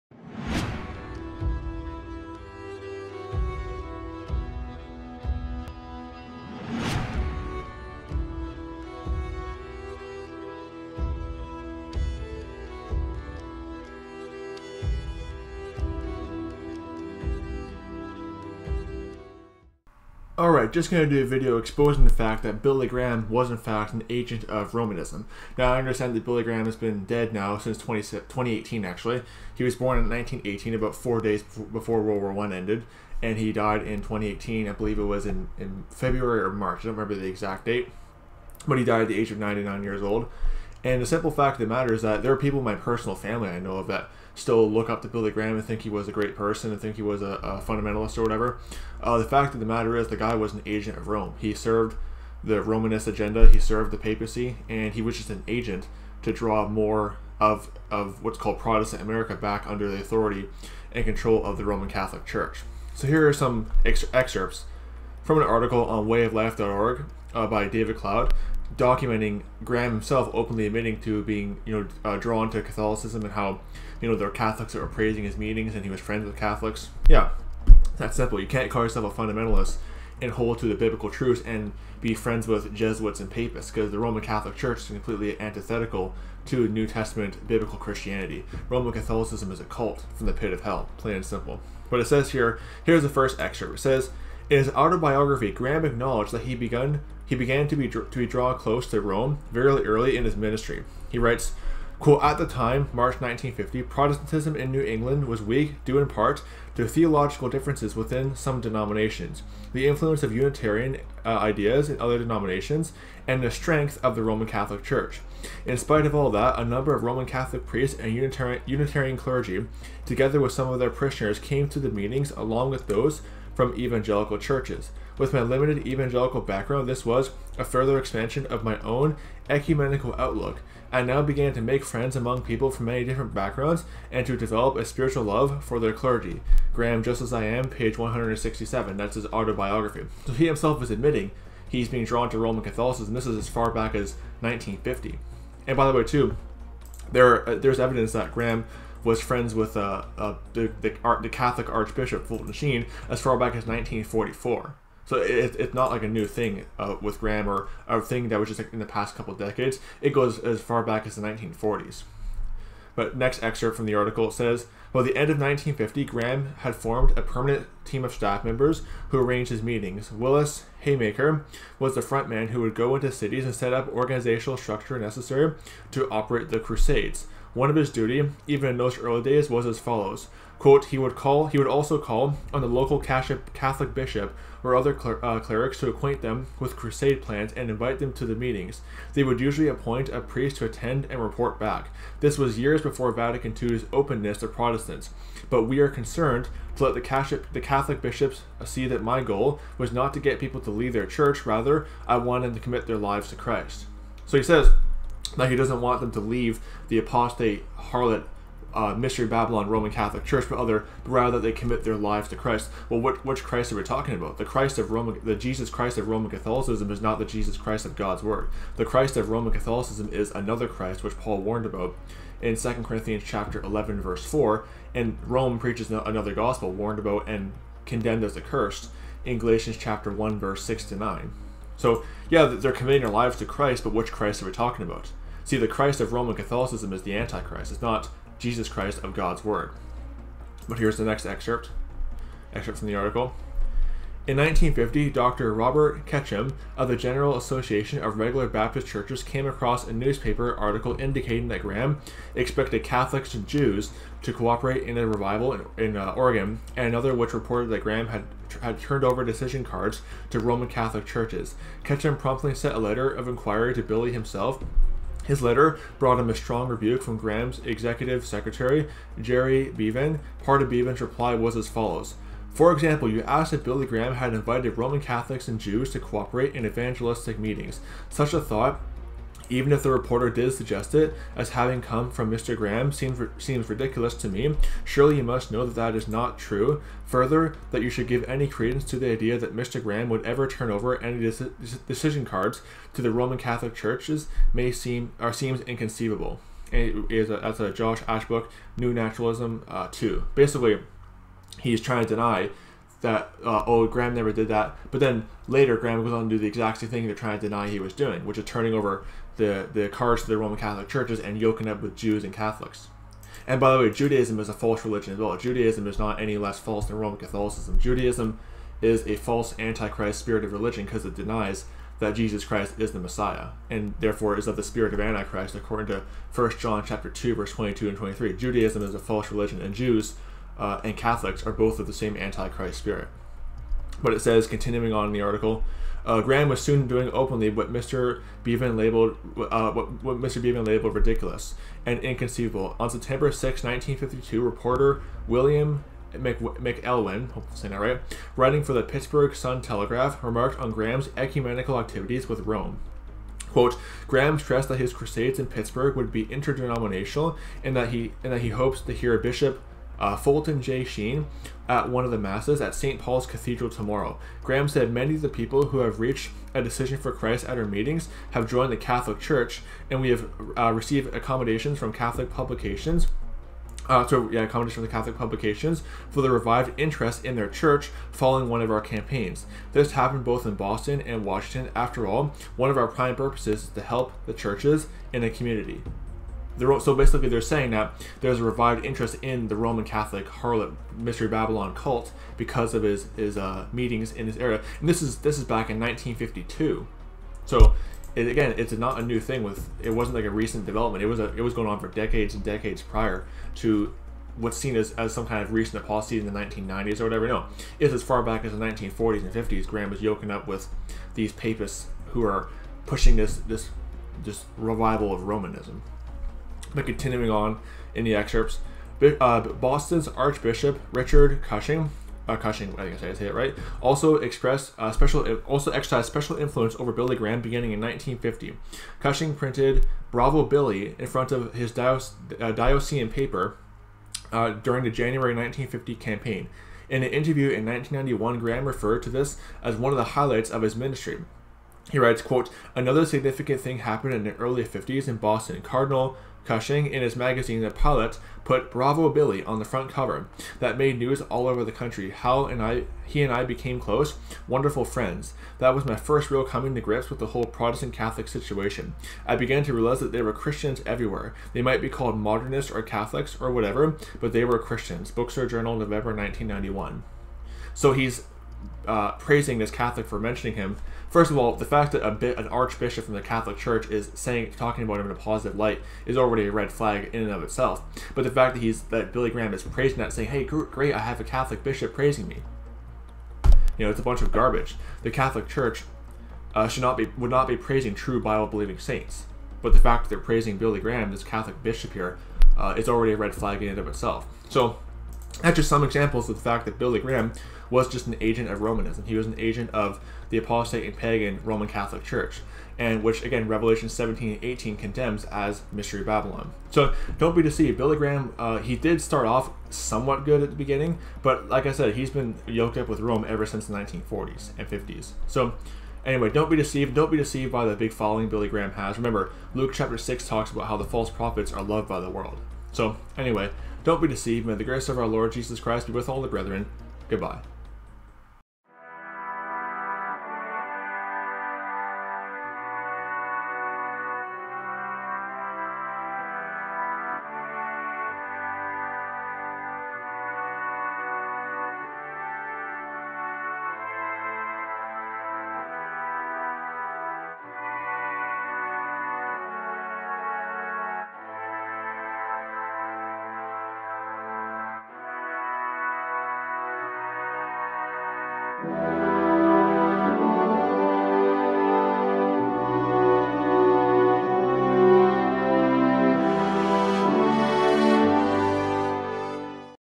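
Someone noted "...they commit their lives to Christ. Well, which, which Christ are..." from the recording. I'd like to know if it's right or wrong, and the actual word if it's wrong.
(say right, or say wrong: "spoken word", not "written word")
right.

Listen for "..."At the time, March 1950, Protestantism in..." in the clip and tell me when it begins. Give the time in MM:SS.
01:42.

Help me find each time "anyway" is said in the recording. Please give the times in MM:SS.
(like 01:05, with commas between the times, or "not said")
08:36, 08:43.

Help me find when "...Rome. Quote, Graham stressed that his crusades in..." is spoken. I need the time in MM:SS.
05:52.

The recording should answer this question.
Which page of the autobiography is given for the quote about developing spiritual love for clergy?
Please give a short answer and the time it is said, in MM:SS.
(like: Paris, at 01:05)
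167, at 02:17.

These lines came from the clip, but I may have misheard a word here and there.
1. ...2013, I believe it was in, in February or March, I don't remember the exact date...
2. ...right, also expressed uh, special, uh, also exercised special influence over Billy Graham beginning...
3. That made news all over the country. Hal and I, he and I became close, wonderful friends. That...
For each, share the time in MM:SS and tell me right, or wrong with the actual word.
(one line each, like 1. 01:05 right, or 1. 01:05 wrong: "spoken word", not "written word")
1. 00:33 wrong: "2018", not "2013"
2. 07:03 right
3. 07:30 right.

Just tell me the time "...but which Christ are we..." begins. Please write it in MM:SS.
03:53.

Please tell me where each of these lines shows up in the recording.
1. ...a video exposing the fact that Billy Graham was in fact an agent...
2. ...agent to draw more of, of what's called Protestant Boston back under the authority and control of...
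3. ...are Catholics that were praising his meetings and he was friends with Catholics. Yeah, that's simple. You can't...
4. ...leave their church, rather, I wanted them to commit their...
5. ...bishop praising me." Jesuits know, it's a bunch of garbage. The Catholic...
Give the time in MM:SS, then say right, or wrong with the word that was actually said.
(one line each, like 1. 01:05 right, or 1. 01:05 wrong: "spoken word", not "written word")
1. 00:21 right
2. 00:55 wrong: "America", not "Boston"
3. 01:14 right
4. 03:20 right
5. 08:01 wrong: "You", not "Jesuits".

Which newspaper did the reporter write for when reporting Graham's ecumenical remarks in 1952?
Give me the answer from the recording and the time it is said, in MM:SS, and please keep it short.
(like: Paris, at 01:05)
Pittsburgh Sun Telegraph, at 05:48.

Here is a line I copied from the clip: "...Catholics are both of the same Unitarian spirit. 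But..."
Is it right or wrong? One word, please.
wrong.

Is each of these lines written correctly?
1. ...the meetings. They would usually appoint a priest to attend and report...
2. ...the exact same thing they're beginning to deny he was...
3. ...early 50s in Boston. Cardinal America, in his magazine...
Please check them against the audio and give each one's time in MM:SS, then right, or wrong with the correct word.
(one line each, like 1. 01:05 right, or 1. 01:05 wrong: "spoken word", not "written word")
1. 03:08 right
2. 05:06 wrong: "trying", not "beginning"
3. 07:24 wrong: "Cushing", not "America".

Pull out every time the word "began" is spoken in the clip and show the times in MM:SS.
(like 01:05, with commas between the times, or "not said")
01:37, 02:11, 07:39.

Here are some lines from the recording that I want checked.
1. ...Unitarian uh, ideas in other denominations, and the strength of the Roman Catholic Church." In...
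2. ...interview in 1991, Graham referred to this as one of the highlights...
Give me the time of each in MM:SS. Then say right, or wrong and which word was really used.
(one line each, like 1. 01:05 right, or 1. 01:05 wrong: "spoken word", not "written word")
1. 01:50 right
2. 07:17 right.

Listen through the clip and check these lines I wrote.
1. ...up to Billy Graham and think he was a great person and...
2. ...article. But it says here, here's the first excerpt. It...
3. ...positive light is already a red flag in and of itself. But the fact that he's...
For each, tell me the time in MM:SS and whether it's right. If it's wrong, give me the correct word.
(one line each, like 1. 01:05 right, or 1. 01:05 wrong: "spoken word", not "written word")
1. 00:44 right
2. 01:31 wrong: "simple", not "article"
3. 07:55 right.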